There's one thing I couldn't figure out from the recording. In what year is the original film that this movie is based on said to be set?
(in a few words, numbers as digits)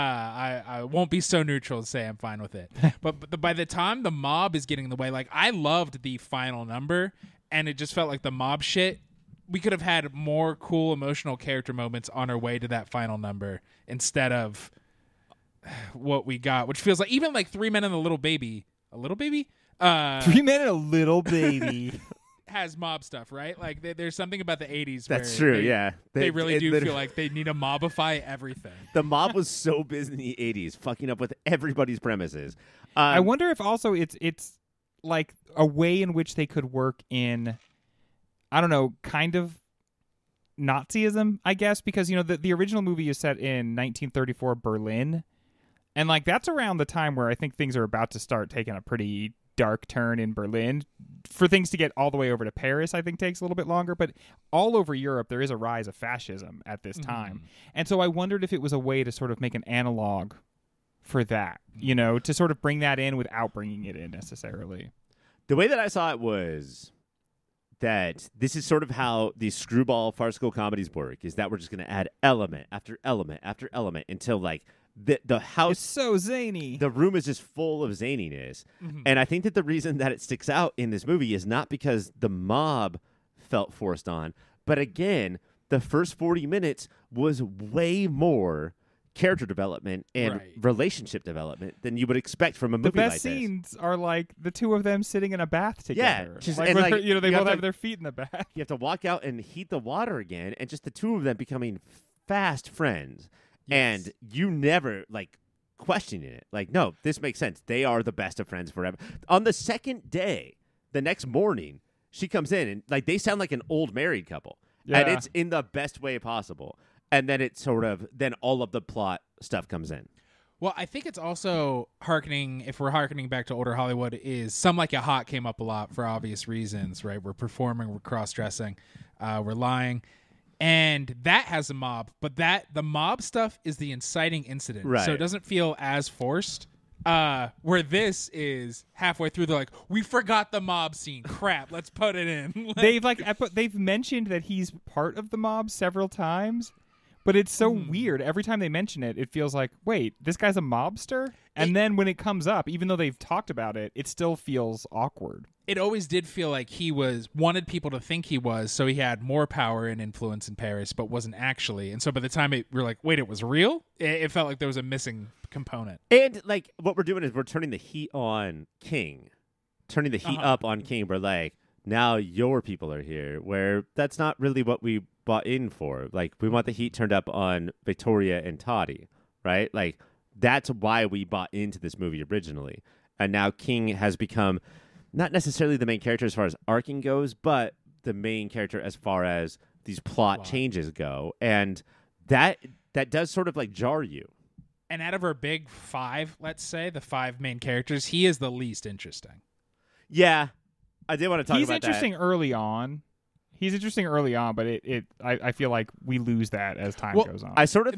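1934.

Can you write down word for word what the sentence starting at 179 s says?
Like that's why we bought into this movie originally.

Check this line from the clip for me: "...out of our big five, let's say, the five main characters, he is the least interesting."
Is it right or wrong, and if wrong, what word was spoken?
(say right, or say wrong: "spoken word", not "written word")
right.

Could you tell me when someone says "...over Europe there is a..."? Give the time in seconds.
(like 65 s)
54 s.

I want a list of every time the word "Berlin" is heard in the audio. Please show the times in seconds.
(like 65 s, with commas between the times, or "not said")
44 s, 50 s.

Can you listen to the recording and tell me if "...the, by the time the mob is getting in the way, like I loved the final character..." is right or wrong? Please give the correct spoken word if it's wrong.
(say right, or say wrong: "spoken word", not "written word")
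wrong: "number", not "character".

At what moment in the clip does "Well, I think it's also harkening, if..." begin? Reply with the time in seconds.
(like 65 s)
120 s.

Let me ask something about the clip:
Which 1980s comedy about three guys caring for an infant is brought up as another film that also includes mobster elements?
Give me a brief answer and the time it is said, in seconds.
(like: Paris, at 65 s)
Three Men and a Little Baby, at 17 s.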